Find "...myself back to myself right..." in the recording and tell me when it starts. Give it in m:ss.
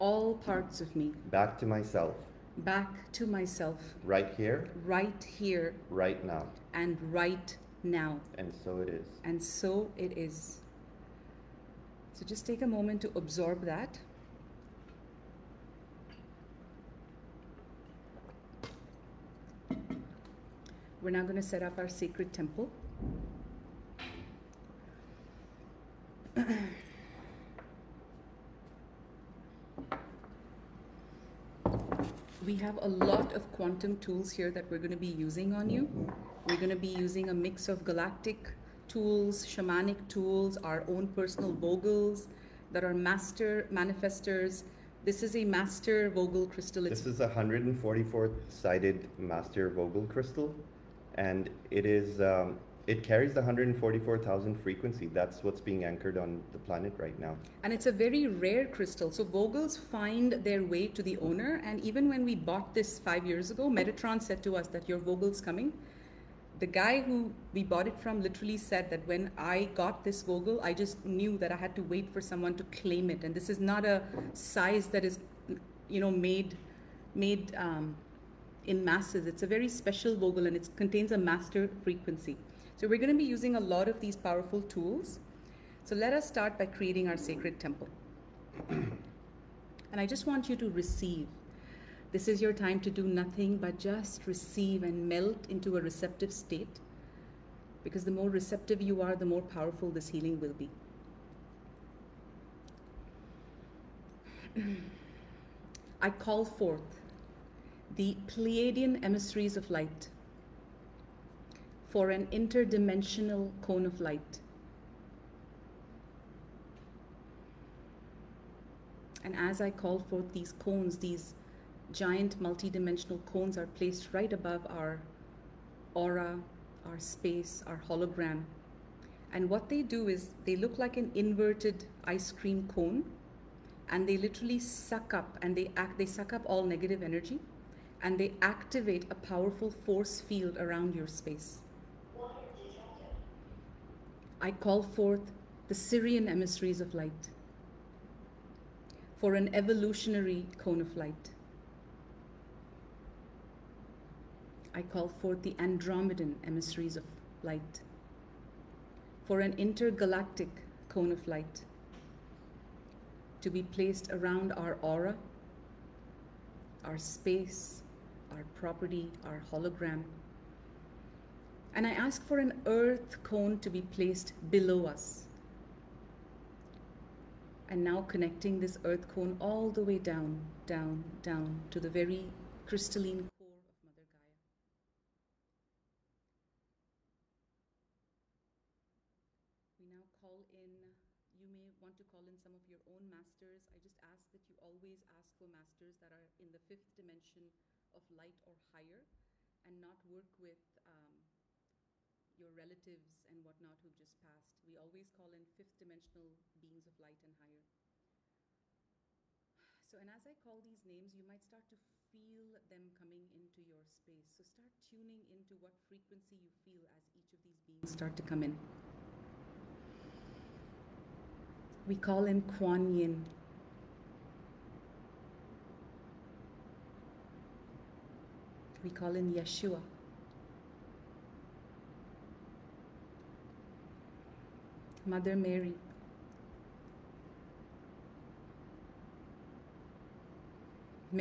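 0:01.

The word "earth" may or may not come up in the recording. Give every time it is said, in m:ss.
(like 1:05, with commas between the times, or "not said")
2:52, 2:58.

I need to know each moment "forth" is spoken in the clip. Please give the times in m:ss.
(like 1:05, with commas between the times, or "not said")
1:46, 1:59, 2:24, 2:35.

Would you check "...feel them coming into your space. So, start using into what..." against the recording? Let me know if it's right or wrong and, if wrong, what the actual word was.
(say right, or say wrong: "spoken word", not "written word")
wrong: "tuning", not "using".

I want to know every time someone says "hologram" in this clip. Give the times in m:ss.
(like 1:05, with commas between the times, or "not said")
2:07, 2:49.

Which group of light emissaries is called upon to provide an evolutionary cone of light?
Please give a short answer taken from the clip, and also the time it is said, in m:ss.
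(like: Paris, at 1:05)
Sirian, at 2:25.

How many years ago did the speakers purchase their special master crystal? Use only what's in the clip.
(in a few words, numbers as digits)
5.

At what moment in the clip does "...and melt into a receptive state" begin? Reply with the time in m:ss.
1:34.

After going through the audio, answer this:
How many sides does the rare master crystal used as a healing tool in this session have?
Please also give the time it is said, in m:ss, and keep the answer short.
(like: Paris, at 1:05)
144, at 0:47.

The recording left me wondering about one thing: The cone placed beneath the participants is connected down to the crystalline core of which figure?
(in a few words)
Mother Gaia.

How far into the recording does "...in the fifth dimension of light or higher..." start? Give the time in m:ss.
3:16.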